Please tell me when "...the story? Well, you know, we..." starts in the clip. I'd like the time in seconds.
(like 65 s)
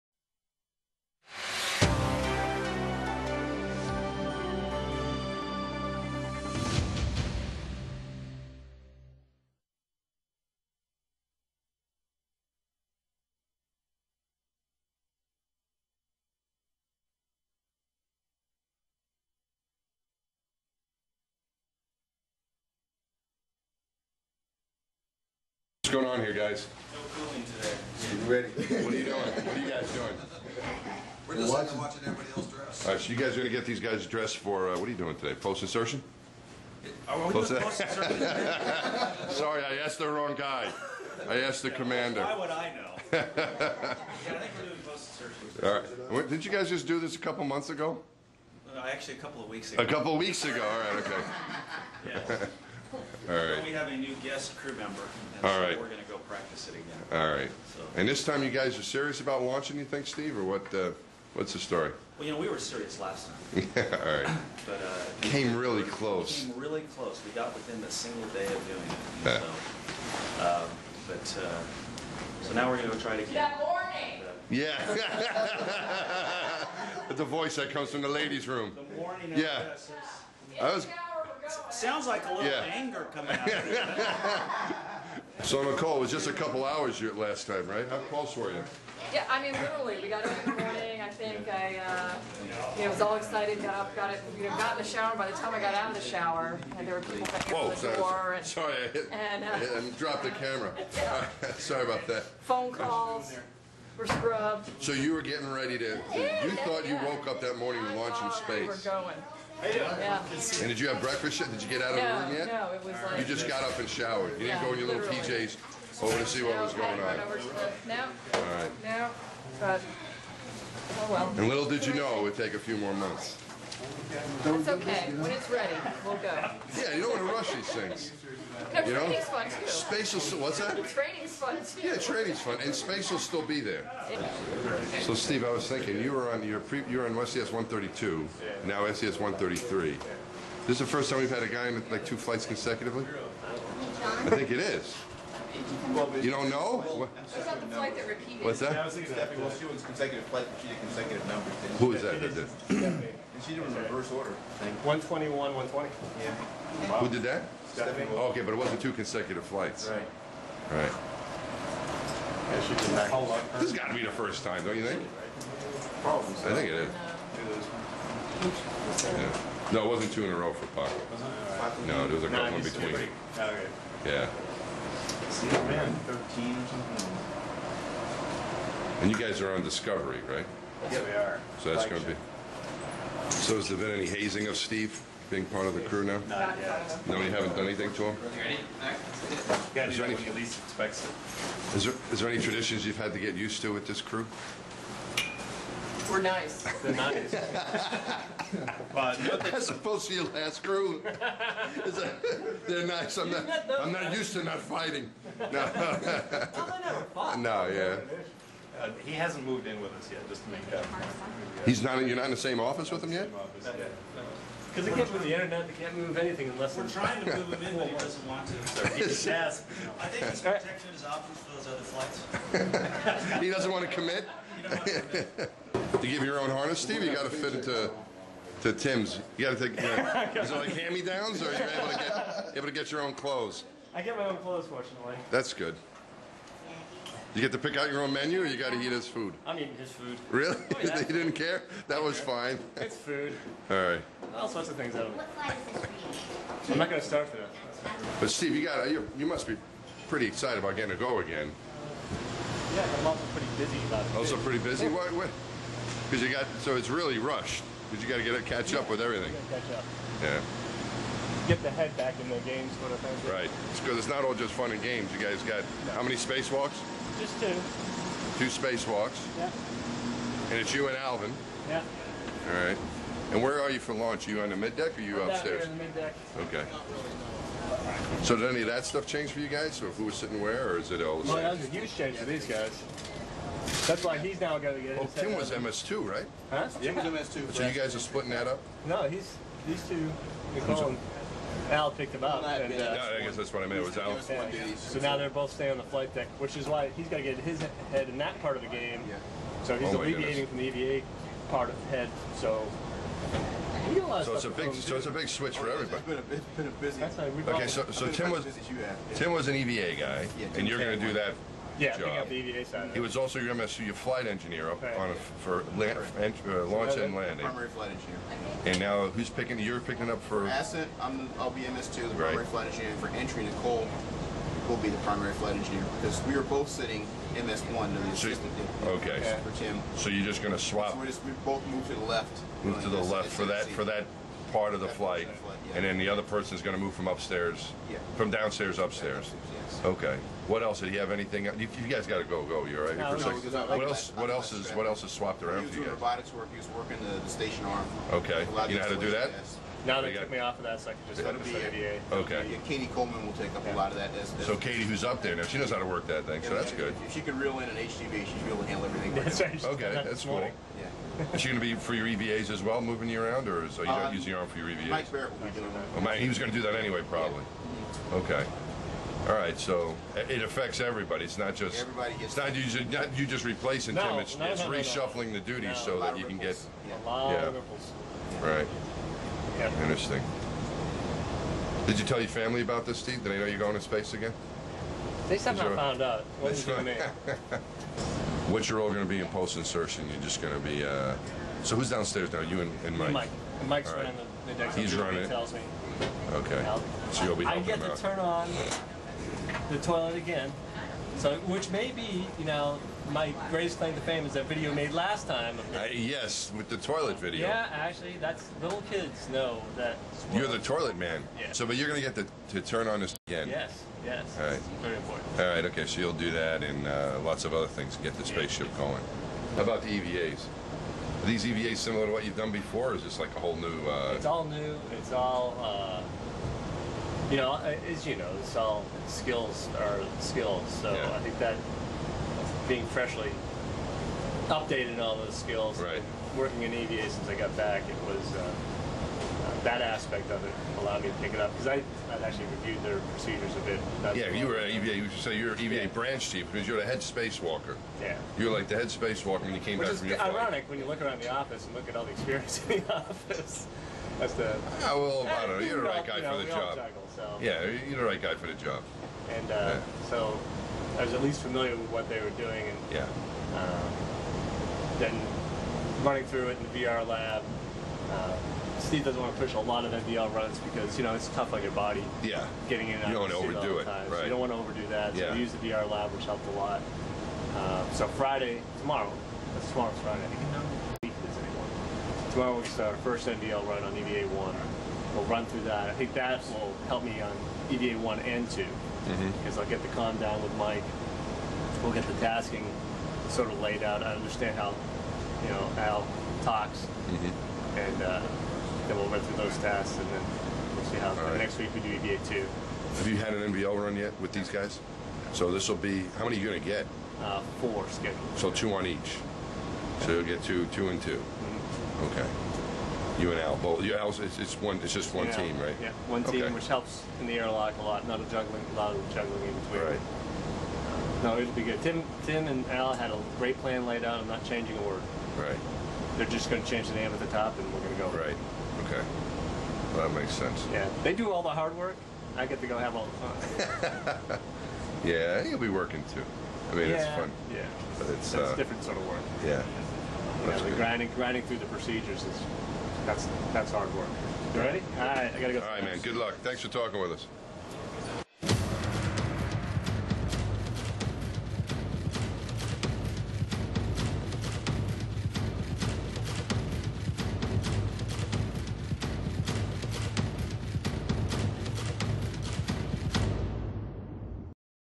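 61 s.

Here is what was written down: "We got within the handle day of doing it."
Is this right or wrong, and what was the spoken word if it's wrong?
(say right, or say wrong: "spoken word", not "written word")
wrong: "single", not "handle".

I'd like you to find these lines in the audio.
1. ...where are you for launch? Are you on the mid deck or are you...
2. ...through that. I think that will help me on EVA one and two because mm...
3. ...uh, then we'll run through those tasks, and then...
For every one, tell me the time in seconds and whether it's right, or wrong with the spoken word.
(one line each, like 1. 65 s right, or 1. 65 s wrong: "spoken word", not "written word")
1. 273 s right
2. 485 s right
3. 498 s right.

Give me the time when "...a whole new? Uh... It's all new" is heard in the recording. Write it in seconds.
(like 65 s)
423 s.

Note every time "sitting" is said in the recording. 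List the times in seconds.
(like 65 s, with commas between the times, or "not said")
280 s, 326 s.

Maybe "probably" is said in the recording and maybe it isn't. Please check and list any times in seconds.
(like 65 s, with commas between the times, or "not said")
166 s, 367 s.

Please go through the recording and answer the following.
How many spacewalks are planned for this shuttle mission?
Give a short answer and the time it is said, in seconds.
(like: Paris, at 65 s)
2, at 267 s.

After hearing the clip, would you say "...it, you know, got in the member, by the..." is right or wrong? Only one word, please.
wrong.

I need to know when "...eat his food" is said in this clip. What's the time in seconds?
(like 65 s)
238 s.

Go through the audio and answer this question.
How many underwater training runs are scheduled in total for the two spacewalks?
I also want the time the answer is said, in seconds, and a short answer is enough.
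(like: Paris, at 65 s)
4, at 507 s.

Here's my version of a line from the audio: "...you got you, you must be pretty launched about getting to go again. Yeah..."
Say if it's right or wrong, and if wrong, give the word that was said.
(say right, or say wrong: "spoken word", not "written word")
wrong: "excited", not "launched".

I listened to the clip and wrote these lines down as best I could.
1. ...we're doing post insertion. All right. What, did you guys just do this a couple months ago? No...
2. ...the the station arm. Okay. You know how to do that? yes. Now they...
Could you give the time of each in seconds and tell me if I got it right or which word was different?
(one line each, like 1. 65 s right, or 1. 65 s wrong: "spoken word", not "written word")
1. 44 s right
2. 347 s right.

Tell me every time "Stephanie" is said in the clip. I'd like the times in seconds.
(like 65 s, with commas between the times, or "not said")
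149 s, 157 s.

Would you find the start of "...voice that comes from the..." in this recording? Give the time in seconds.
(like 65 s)
77 s.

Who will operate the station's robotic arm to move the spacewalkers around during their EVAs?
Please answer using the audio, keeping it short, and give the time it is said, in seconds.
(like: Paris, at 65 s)
Mike Barratt, at 364 s.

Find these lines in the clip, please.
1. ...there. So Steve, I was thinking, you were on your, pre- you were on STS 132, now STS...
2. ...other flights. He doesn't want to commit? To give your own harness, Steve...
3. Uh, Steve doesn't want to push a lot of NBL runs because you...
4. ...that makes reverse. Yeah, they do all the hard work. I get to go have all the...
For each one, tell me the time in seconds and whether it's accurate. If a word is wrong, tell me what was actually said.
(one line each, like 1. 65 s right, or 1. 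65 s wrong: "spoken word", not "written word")
1. 133 s right
2. 222 s right
3. 468 s right
4. 530 s wrong: "sense", not "reverse".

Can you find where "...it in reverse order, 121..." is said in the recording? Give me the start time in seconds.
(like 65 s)
153 s.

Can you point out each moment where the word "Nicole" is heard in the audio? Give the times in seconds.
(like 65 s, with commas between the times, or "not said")
85 s, 290 s, 323 s.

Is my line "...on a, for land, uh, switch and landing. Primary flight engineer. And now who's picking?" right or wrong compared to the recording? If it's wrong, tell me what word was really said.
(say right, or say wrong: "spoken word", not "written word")
wrong: "launch", not "switch".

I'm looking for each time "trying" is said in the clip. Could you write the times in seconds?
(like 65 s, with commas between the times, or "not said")
216 s.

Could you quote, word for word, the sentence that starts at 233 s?
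I get my own clothes, fortunately.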